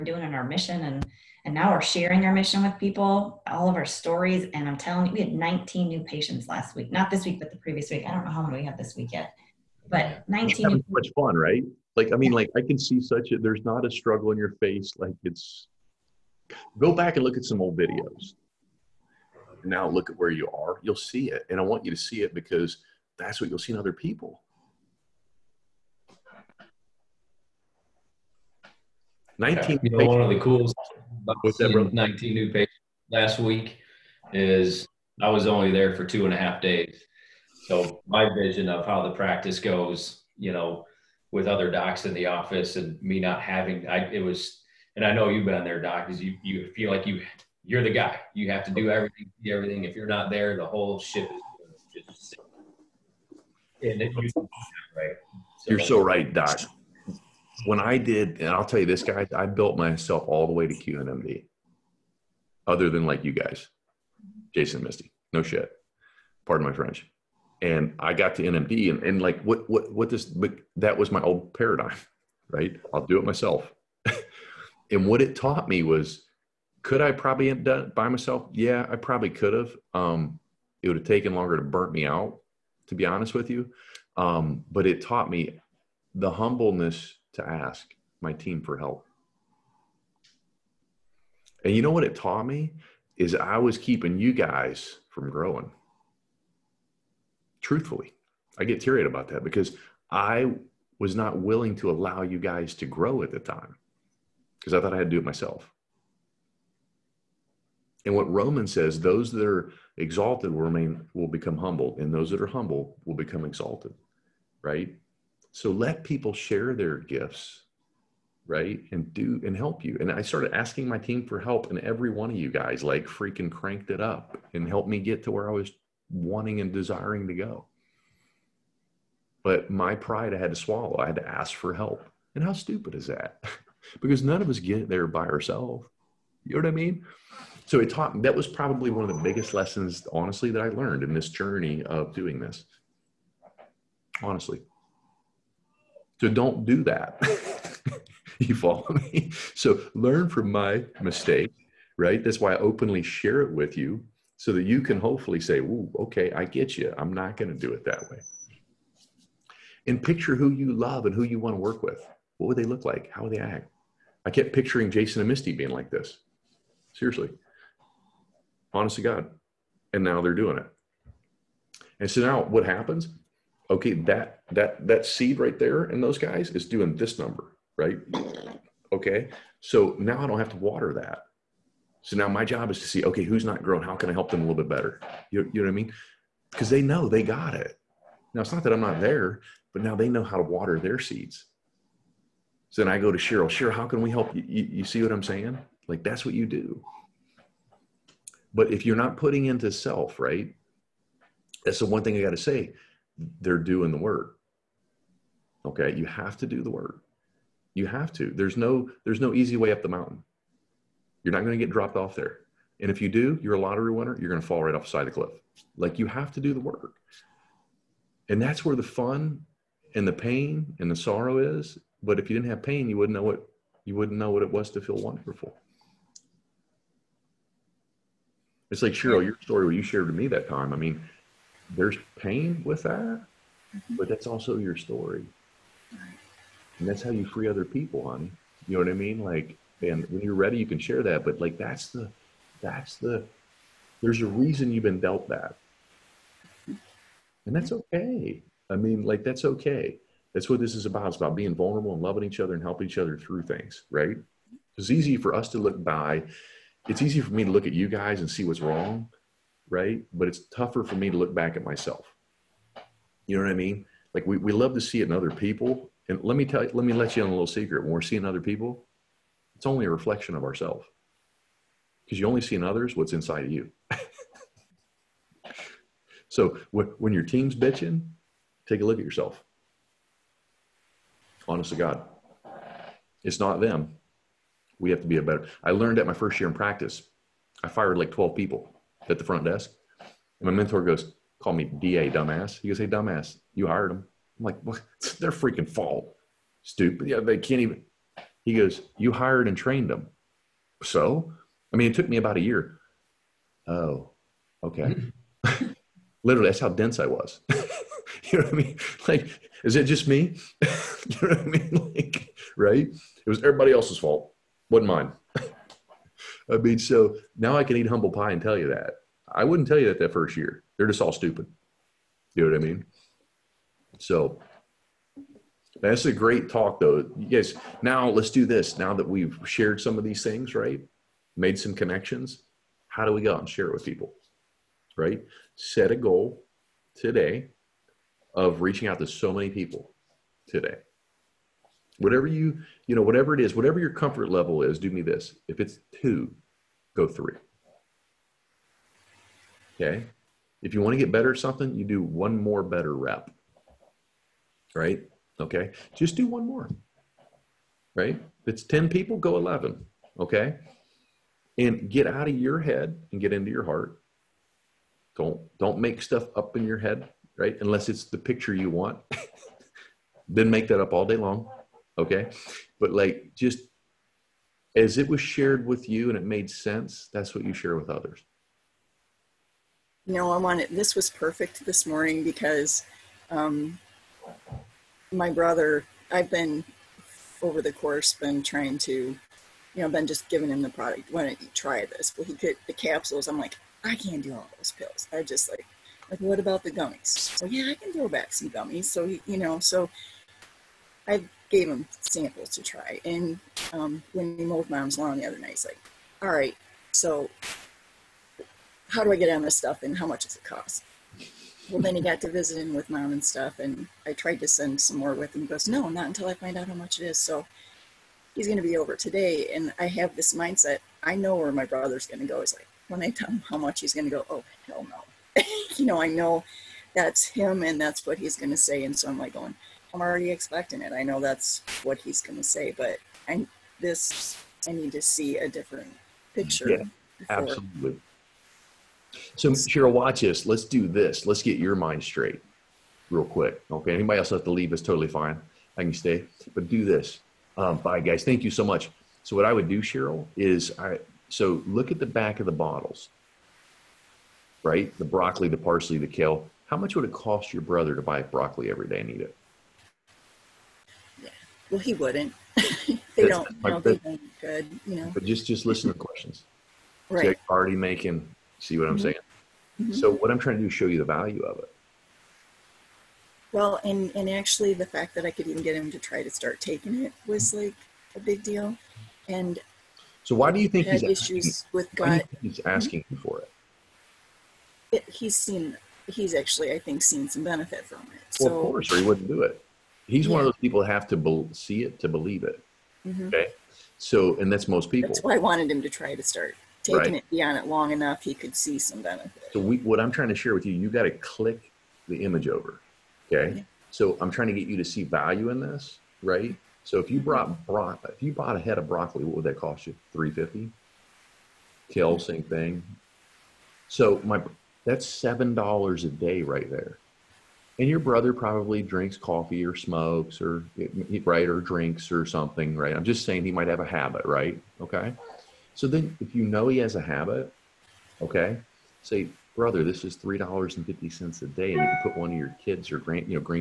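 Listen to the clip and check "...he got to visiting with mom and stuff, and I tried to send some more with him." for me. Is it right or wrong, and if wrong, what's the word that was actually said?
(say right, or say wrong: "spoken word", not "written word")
right.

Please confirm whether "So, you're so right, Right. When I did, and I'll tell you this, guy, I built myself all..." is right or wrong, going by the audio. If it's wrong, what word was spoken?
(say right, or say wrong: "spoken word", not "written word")
wrong: "Doc", not "Right".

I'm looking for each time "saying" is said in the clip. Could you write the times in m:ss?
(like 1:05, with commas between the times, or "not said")
3:15, 7:49, 8:43.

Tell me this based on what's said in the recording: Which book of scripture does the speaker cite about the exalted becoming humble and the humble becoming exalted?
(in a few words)
Romans.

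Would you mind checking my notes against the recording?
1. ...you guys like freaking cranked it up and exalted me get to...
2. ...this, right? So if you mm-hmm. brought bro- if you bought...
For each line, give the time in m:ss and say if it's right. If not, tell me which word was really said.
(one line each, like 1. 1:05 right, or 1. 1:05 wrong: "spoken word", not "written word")
1. 2:02 wrong: "helped", not "exalted"
2. 8:25 right.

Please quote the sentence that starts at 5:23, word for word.
So that's a great talk, though.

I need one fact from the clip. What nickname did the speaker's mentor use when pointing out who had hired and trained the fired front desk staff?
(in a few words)
DA.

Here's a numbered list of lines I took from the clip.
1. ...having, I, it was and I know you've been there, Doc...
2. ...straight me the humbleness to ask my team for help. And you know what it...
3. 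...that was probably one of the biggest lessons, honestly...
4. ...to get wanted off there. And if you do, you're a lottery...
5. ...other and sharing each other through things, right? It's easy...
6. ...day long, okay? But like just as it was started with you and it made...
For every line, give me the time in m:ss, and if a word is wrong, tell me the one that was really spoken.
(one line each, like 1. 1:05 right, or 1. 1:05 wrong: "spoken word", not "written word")
1. 0:43 right
2. 1:25 wrong: "taught", not "straight"
3. 2:18 right
4. 3:31 wrong: "dropped", not "wanted"
5. 4:12 wrong: "helping", not "sharing"
6. 6:11 wrong: "shared", not "started".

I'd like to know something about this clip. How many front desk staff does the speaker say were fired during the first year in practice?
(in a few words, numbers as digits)
12.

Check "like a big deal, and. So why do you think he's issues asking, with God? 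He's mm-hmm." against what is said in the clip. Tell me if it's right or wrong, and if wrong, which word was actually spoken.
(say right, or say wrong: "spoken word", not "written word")
right.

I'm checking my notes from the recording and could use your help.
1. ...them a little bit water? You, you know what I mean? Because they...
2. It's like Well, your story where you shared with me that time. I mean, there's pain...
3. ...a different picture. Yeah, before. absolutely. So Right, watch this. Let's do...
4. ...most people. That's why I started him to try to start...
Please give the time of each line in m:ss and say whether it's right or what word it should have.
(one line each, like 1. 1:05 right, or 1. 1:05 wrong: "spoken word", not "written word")
1. 3:04 wrong: "better", not "water"
2. 3:48 wrong: "Cheryl", not "Well"
3. 7:15 wrong: "Cheryl", not "Right"
4. 8:14 wrong: "wanted", not "started".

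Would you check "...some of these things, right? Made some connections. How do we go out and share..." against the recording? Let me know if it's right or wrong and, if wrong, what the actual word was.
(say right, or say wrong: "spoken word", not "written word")
right.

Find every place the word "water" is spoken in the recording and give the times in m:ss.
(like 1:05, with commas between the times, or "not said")
3:00, 3:10.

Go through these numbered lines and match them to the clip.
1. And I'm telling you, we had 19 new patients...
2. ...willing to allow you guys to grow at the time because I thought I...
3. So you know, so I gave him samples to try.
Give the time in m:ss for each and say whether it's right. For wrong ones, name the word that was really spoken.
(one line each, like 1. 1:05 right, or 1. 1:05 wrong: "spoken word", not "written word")
1. 0:04 right
2. 1:41 right
3. 6:38 right.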